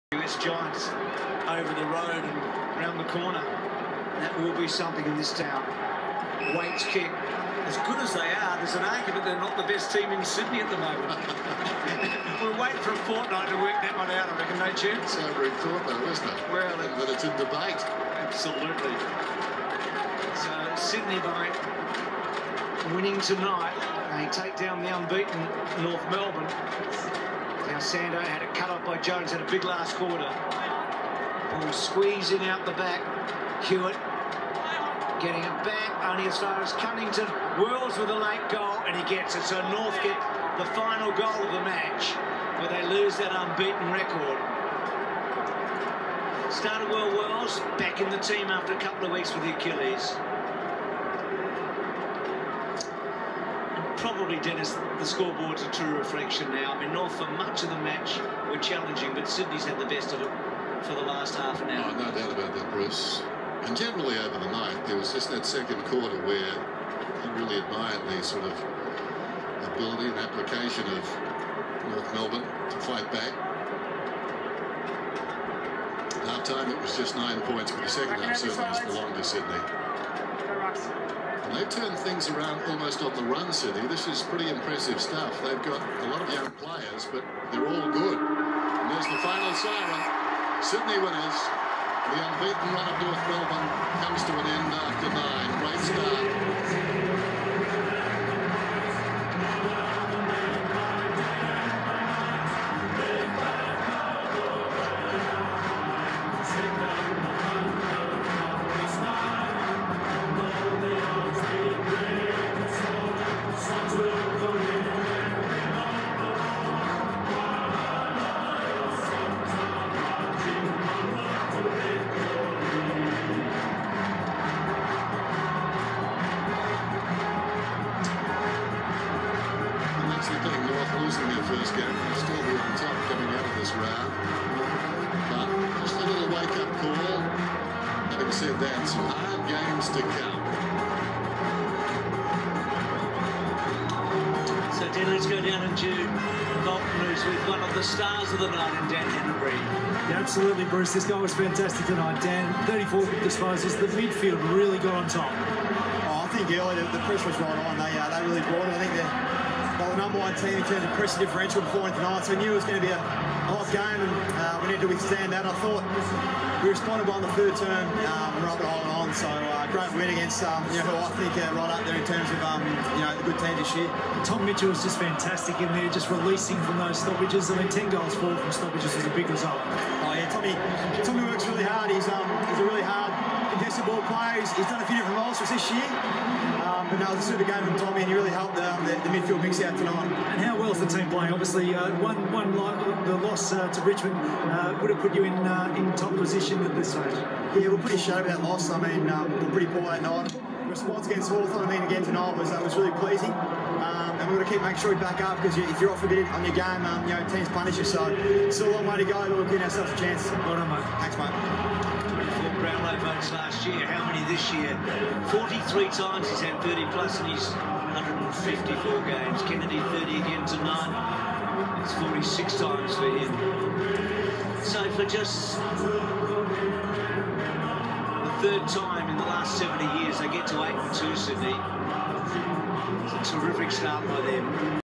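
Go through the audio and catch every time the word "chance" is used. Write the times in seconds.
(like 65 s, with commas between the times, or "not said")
14 s, 209 s.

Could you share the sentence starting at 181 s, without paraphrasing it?
He's, um, he's a really hard ball plays.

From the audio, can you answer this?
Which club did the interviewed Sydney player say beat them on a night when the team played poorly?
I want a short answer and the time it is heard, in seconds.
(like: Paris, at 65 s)
Richmond, at 193 s.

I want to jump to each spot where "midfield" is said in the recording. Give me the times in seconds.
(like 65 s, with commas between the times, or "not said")
153 s, 189 s.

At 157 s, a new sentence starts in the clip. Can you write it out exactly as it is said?
They, uh, they really brought it.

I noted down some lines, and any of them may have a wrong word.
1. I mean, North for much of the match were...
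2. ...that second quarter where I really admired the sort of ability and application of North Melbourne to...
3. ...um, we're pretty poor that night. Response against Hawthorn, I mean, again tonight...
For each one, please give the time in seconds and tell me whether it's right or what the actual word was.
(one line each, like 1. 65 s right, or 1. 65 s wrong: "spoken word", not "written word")
1. 56 s right
2. 65 s right
3. 199 s right.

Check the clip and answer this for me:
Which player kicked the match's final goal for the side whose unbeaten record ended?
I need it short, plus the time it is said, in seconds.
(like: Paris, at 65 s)
Cunnington, at 36 s.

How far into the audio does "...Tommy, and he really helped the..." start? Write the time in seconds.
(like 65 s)
187 s.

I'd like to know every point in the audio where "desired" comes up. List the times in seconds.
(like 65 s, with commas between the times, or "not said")
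not said.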